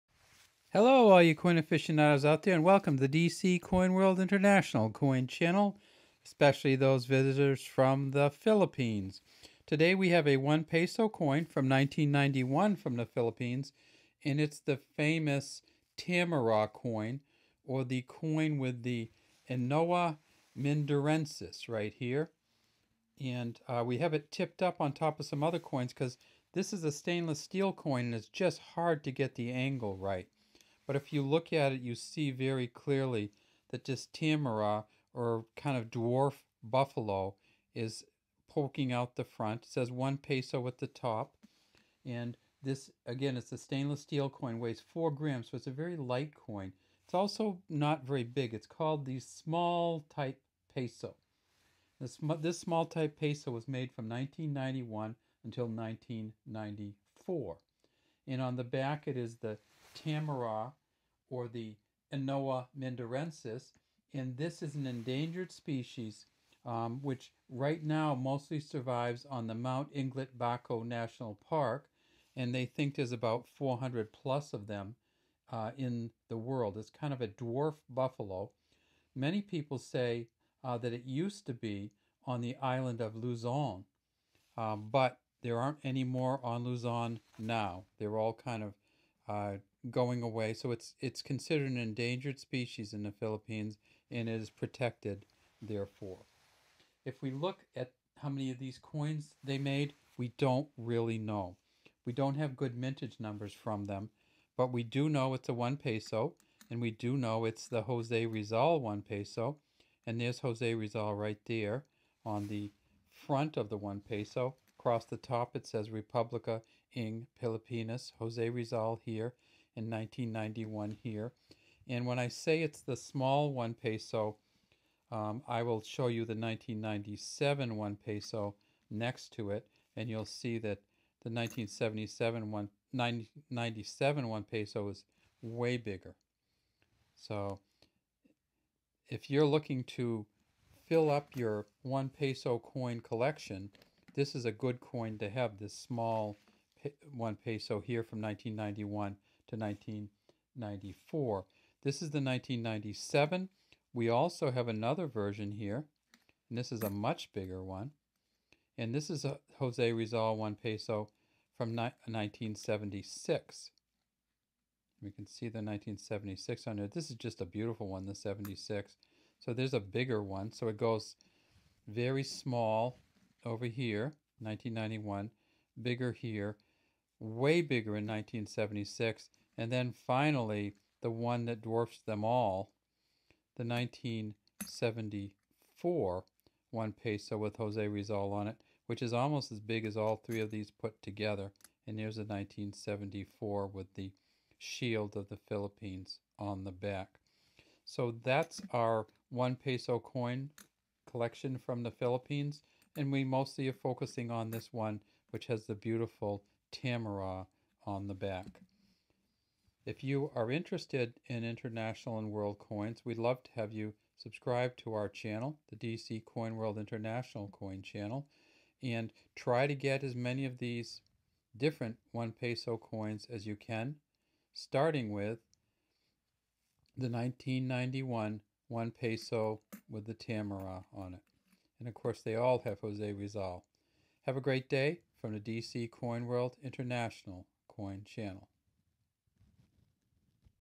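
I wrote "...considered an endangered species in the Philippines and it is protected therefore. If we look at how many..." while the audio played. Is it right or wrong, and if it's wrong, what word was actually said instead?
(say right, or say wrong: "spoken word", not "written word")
right.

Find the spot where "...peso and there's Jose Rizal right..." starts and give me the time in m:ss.
1:49.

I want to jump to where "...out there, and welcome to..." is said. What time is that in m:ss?
0:02.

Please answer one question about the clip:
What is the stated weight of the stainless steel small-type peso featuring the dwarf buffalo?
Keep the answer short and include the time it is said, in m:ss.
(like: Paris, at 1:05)
4 grams, at 0:44.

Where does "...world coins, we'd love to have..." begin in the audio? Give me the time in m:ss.
3:32.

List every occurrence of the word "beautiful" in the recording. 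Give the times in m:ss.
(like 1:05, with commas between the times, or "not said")
2:47, 3:25.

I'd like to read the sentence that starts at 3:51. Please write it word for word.
And of course, they all have Jose Rizal.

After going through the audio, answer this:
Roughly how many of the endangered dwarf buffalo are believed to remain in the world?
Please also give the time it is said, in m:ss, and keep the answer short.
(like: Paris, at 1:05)
400 plus, at 1:13.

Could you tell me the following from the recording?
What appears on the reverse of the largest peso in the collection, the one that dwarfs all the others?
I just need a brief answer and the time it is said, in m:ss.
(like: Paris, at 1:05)
Shield of the Philippines, at 3:14.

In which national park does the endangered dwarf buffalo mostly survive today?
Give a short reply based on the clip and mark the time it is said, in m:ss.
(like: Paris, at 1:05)
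Mount Iglit Baco National Park, at 1:09.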